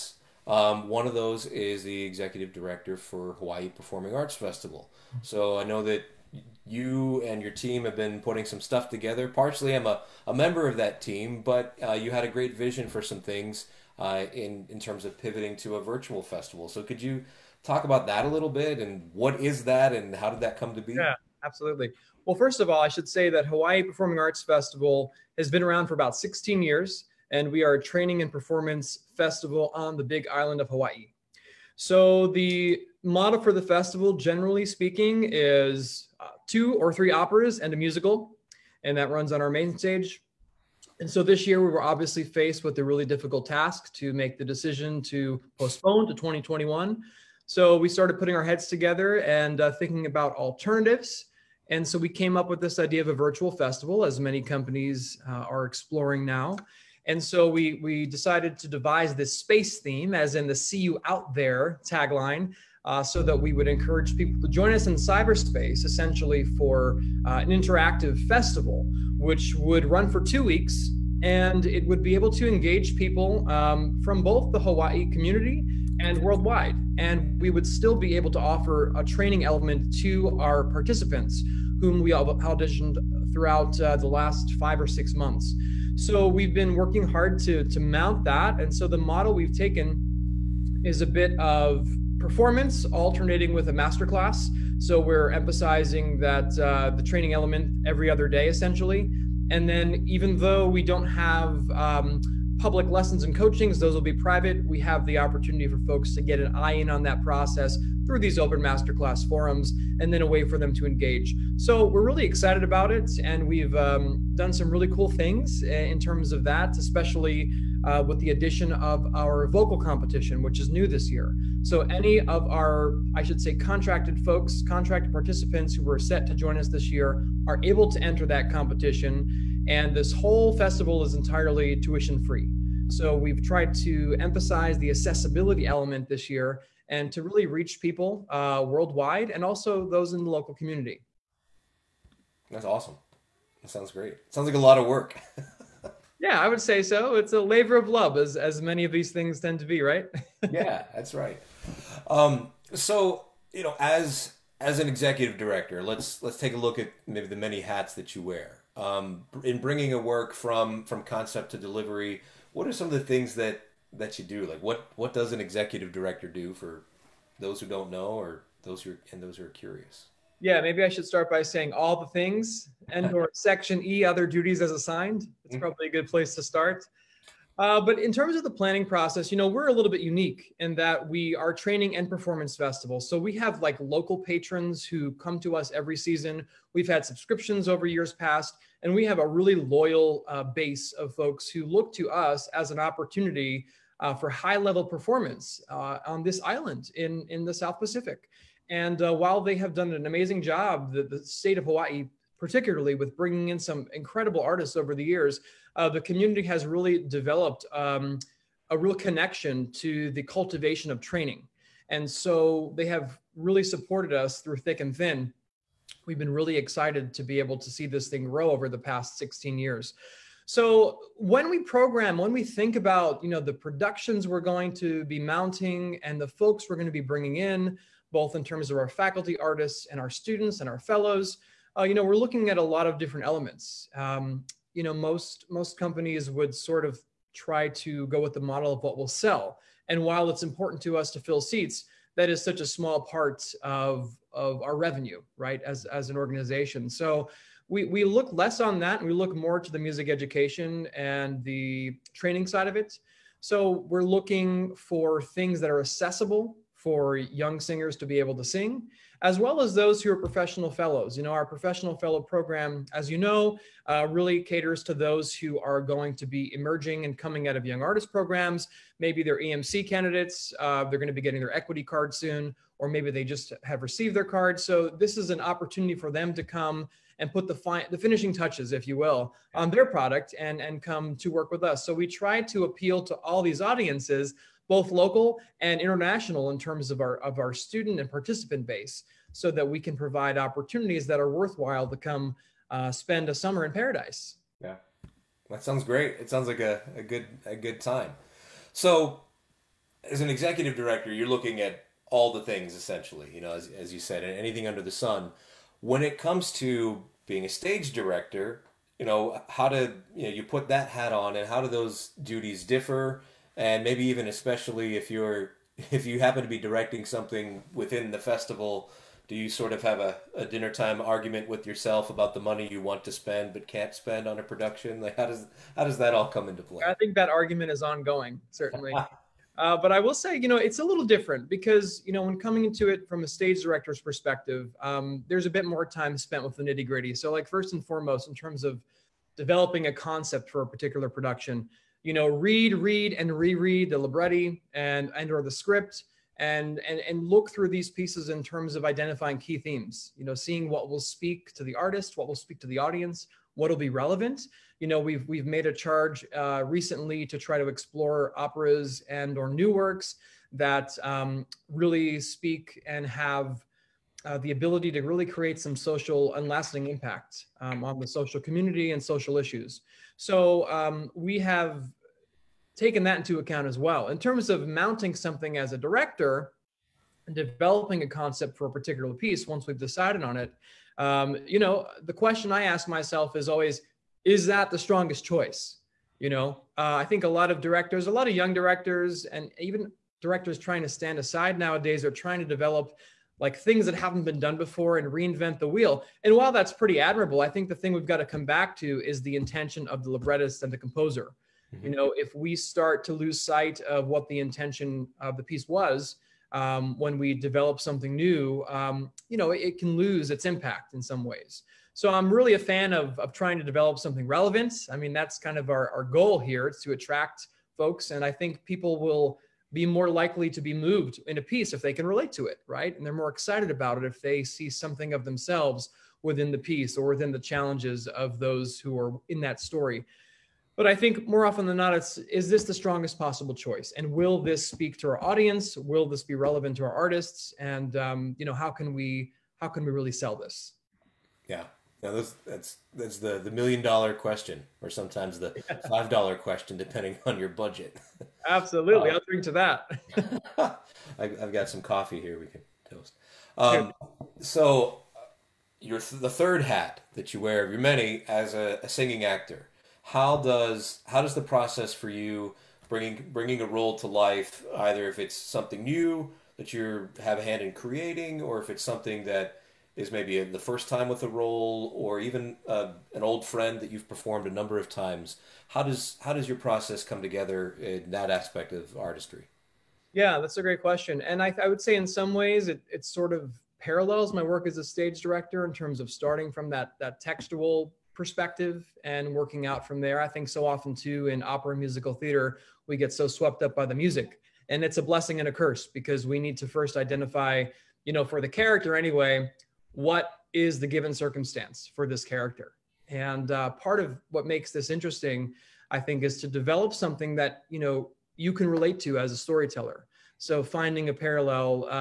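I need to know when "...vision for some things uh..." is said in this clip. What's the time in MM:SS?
00:12.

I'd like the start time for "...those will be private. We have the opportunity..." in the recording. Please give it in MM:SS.
01:43.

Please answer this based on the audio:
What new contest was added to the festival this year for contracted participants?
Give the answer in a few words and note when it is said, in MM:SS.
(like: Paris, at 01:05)
Vocal competition, at 01:59.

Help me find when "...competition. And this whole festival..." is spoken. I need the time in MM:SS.
02:08.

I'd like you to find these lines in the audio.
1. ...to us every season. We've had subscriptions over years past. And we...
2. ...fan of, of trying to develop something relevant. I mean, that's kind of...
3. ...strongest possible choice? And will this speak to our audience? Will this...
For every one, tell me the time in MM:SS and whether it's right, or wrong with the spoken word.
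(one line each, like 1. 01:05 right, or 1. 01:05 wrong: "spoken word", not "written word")
1. 03:05 right
2. 06:52 right
3. 07:12 right.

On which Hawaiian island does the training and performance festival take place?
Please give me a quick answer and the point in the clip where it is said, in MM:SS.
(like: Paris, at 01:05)
Big Island, at 00:30.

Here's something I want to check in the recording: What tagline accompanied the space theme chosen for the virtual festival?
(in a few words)
See you out there.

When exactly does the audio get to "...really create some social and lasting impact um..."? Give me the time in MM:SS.
06:05.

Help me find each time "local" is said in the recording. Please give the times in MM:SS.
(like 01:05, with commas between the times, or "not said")
02:20, 03:03, 04:44.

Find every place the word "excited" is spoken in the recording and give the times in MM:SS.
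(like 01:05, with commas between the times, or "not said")
01:52, 03:36, 07:03.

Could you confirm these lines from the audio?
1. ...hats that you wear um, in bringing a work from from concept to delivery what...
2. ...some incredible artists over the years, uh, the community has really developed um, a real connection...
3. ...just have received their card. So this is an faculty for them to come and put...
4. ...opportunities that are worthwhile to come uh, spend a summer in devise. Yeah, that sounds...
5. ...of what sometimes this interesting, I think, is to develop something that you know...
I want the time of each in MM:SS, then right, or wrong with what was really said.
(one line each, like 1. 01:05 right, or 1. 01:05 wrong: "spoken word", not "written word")
1. 02:37 right
2. 03:23 right
3. 04:33 wrong: "opportunity", not "faculty"
4. 04:50 wrong: "paradise", not "devise"
5. 08:23 wrong: "makes", not "sometimes".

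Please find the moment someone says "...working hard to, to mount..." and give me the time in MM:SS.
01:26.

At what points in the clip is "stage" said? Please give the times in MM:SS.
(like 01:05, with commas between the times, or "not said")
00:39, 05:07, 05:33, 08:04.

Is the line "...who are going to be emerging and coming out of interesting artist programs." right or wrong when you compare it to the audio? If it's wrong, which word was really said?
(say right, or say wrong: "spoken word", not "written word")
wrong: "young", not "interesting".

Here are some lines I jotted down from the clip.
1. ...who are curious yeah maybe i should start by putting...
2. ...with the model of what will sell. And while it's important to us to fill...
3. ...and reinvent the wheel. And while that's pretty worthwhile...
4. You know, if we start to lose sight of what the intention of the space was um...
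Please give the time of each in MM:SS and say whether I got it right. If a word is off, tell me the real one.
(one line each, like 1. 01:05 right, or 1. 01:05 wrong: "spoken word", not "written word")
1. 02:49 wrong: "saying", not "putting"
2. 03:58 right
3. 06:34 wrong: "admirable", not "worthwhile"
4. 06:41 wrong: "piece", not "space".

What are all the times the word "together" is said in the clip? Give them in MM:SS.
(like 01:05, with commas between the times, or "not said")
00:08, 00:48, 07:57.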